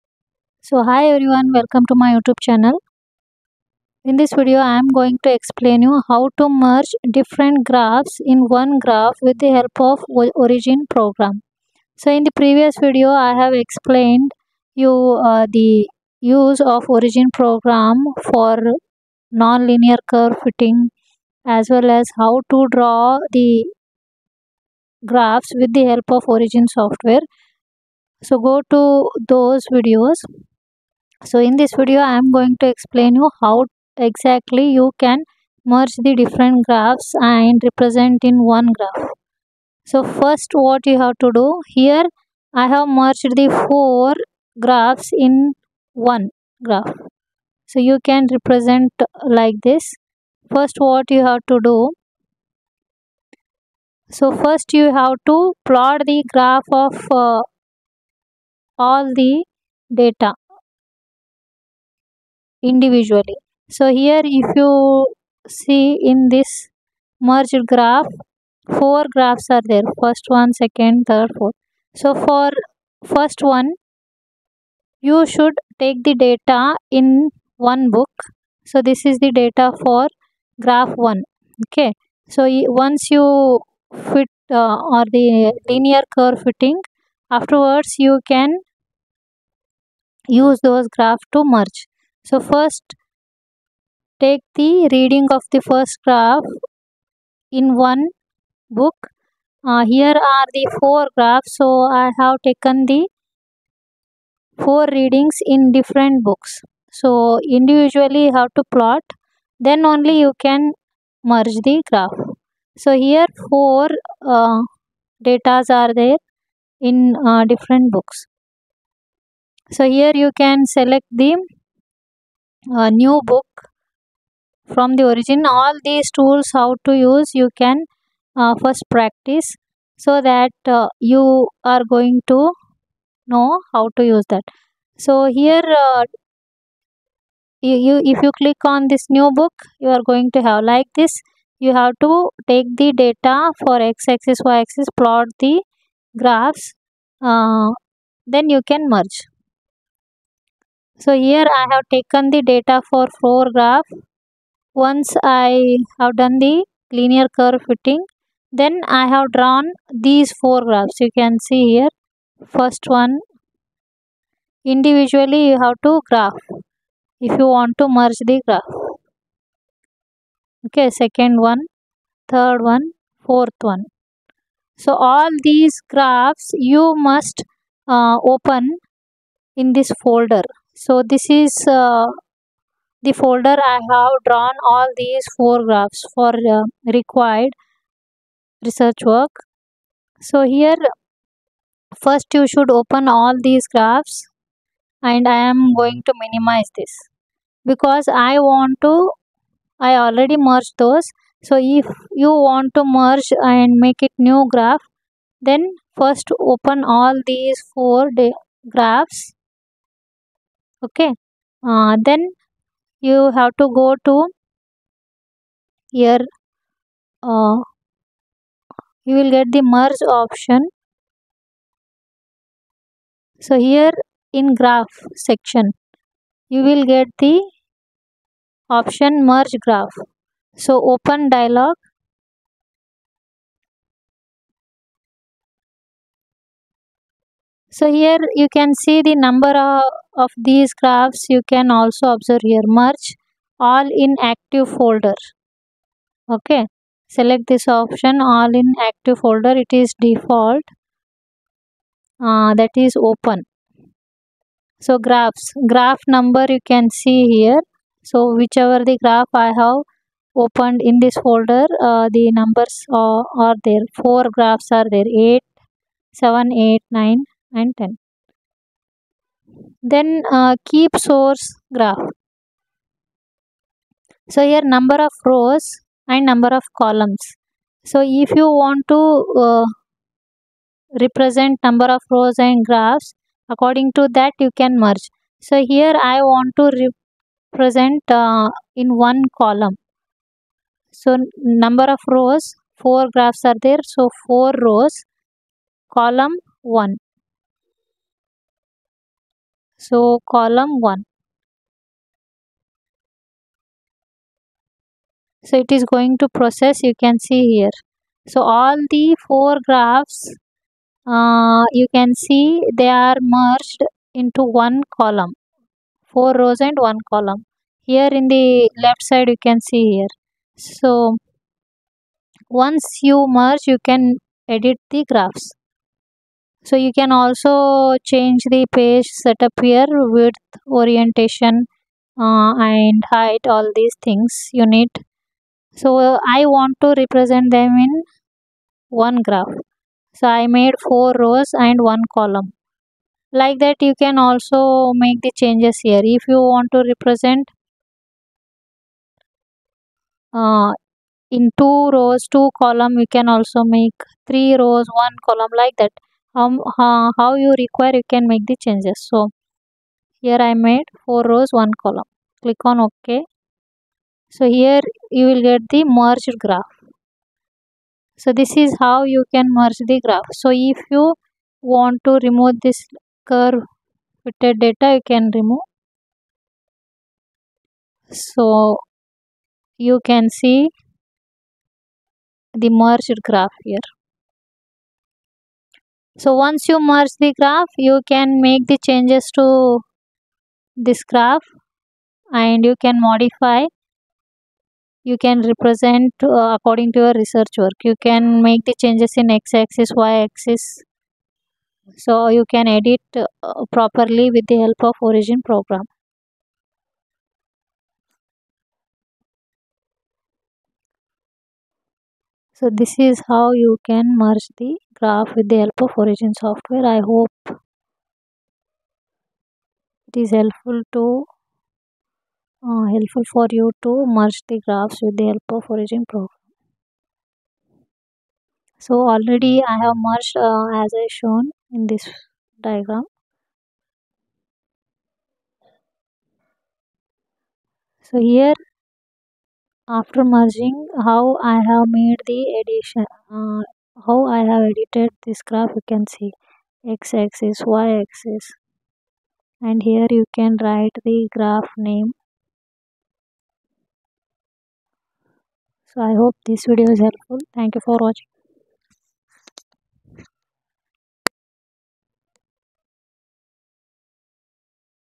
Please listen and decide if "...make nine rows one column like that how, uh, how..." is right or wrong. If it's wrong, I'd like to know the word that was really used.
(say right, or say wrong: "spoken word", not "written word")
wrong: "three", not "nine".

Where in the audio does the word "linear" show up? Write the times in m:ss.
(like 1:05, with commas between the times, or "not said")
0:19, 1:25, 2:36.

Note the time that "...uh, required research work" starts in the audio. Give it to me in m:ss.
3:06.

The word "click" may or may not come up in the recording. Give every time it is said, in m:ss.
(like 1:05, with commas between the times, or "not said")
2:18, 6:02.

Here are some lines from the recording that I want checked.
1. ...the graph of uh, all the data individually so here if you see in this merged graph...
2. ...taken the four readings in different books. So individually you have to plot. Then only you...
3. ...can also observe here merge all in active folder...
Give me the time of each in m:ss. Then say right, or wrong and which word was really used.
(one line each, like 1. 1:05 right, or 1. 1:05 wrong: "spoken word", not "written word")
1. 0:56 right
2. 1:42 right
3. 4:01 right.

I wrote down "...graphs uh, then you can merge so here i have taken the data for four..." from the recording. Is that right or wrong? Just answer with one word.
right.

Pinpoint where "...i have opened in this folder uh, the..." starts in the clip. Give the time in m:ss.
4:19.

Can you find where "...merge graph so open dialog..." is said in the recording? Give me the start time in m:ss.
3:49.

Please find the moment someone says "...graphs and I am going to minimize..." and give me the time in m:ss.
3:13.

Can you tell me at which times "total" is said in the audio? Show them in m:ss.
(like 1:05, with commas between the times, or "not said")
not said.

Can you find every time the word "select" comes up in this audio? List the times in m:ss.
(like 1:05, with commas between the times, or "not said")
2:00, 4:07.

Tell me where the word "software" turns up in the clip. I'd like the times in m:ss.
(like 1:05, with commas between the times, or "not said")
0:26, 6:56.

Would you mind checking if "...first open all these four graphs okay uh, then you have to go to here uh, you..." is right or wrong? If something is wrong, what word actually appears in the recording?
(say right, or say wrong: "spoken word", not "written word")
right.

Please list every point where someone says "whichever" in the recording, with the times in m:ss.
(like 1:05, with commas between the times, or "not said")
4:18.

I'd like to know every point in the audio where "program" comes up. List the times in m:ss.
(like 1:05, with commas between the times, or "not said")
0:10, 0:17, 6:45, 7:06.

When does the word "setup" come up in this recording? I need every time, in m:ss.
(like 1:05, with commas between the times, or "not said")
5:29.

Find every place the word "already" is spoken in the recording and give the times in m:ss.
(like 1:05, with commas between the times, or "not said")
3:20, 7:09.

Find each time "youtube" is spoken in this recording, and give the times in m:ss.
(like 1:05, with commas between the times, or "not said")
0:02.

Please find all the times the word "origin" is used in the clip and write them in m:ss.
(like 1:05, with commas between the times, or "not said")
0:10, 0:16, 0:26, 2:05, 6:45, 6:56, 7:05.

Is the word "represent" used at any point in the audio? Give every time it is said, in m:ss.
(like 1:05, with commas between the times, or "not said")
0:37, 0:48, 4:41, 4:46, 5:37, 5:46, 6:35.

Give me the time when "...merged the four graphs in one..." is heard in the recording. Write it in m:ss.
0:42.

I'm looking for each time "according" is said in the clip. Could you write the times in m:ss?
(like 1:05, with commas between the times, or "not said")
4:43, 6:36.